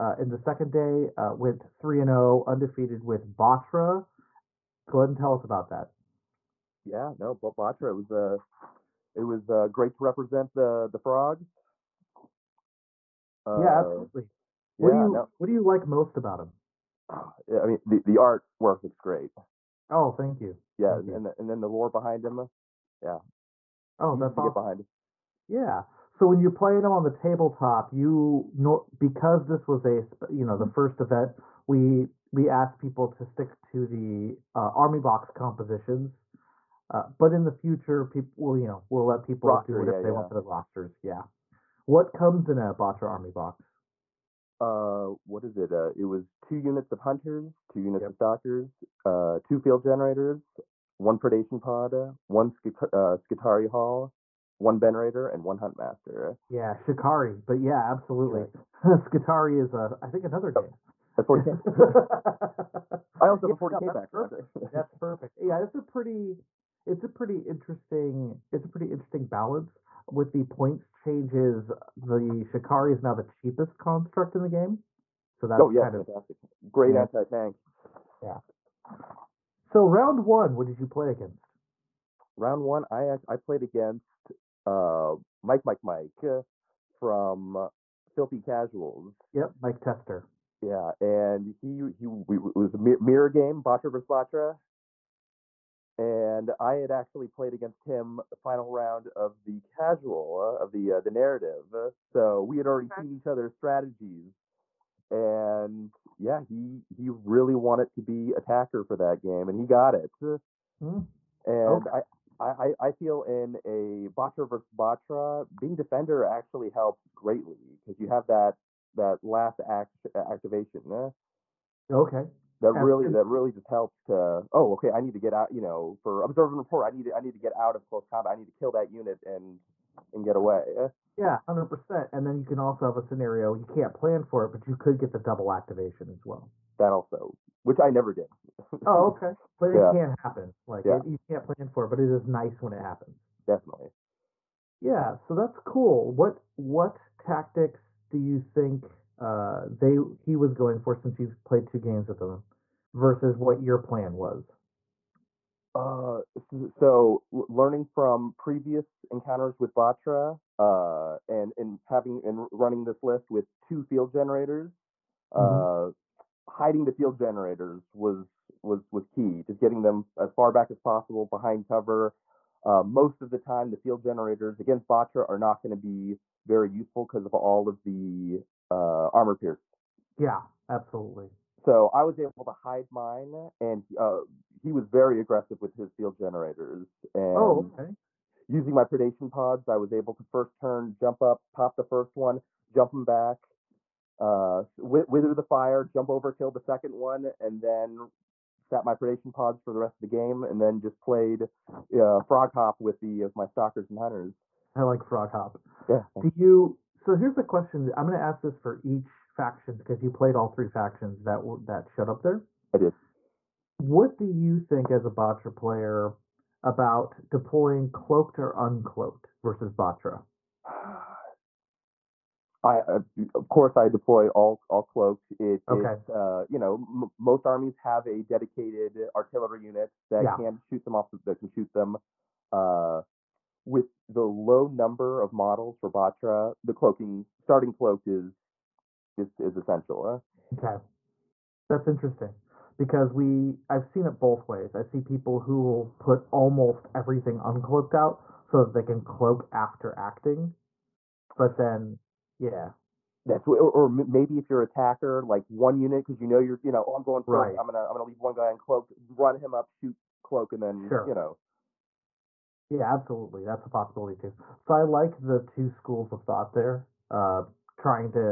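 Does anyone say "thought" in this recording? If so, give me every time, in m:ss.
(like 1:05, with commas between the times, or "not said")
4:26.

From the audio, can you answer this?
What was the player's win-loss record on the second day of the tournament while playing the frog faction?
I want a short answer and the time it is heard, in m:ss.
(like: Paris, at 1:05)
3 and 0, at 0:01.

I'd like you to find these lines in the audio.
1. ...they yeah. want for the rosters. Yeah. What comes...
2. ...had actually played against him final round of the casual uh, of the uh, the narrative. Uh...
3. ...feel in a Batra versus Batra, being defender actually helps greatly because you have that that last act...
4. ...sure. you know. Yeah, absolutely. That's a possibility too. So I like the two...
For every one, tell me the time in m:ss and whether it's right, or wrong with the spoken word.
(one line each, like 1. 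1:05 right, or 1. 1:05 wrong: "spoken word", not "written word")
1. 0:40 right
2. 1:36 right
3. 1:52 right
4. 4:20 right.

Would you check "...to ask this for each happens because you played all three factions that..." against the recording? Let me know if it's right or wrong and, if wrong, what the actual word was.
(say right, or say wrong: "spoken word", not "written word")
wrong: "factions", not "happens".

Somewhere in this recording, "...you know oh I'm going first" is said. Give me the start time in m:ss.
4:16.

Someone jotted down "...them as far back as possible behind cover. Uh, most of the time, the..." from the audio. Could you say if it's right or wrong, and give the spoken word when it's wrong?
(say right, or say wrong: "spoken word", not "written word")
right.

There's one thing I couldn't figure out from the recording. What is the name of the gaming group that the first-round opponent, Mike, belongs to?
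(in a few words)
Filthy Casuals.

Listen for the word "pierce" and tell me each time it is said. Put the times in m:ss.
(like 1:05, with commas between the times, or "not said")
2:59.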